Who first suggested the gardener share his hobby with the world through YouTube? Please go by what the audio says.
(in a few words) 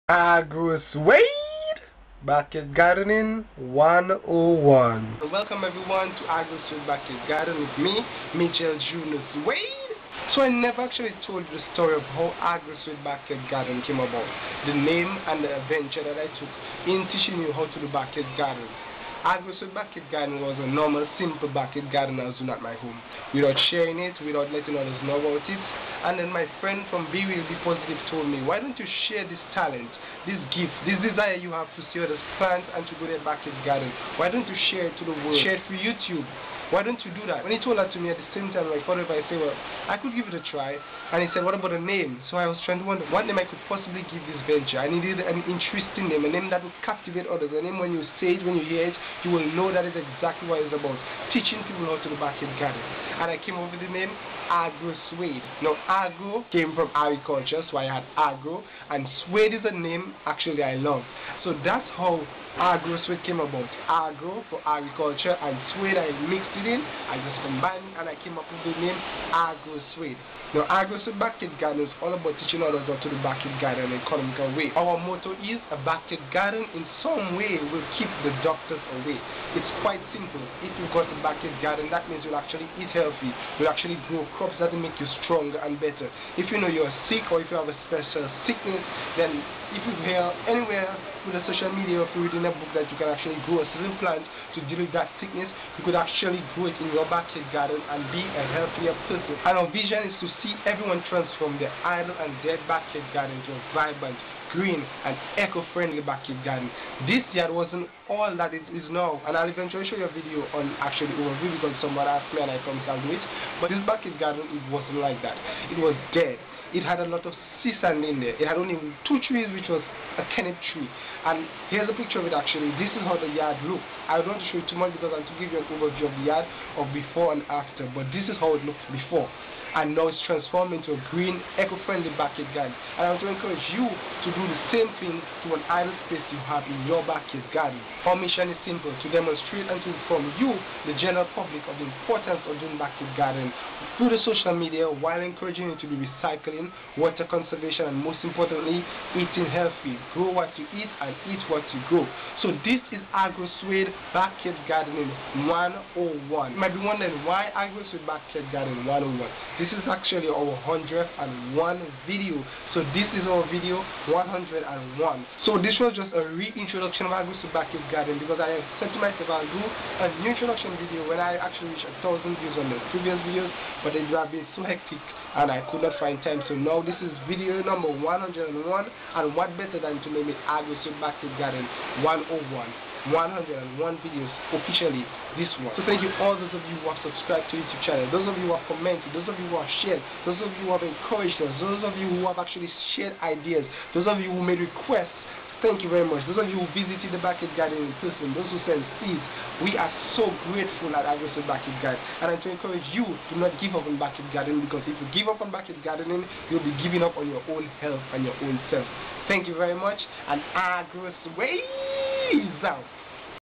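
Be Will Be Positive.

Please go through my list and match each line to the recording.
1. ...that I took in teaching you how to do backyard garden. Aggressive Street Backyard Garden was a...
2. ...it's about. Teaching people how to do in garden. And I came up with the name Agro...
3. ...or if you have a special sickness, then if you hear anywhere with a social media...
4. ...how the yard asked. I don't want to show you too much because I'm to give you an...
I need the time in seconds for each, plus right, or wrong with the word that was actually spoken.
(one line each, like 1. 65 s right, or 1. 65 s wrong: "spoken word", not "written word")
1. 16 s right
2. 50 s right
3. 87 s right
4. 123 s wrong: "looked", not "asked".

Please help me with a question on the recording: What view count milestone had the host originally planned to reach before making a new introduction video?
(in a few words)
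1000 views.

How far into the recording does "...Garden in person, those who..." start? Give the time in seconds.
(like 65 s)
197 s.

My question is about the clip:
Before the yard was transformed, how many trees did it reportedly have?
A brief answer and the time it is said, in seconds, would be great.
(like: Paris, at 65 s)
2, at 119 s.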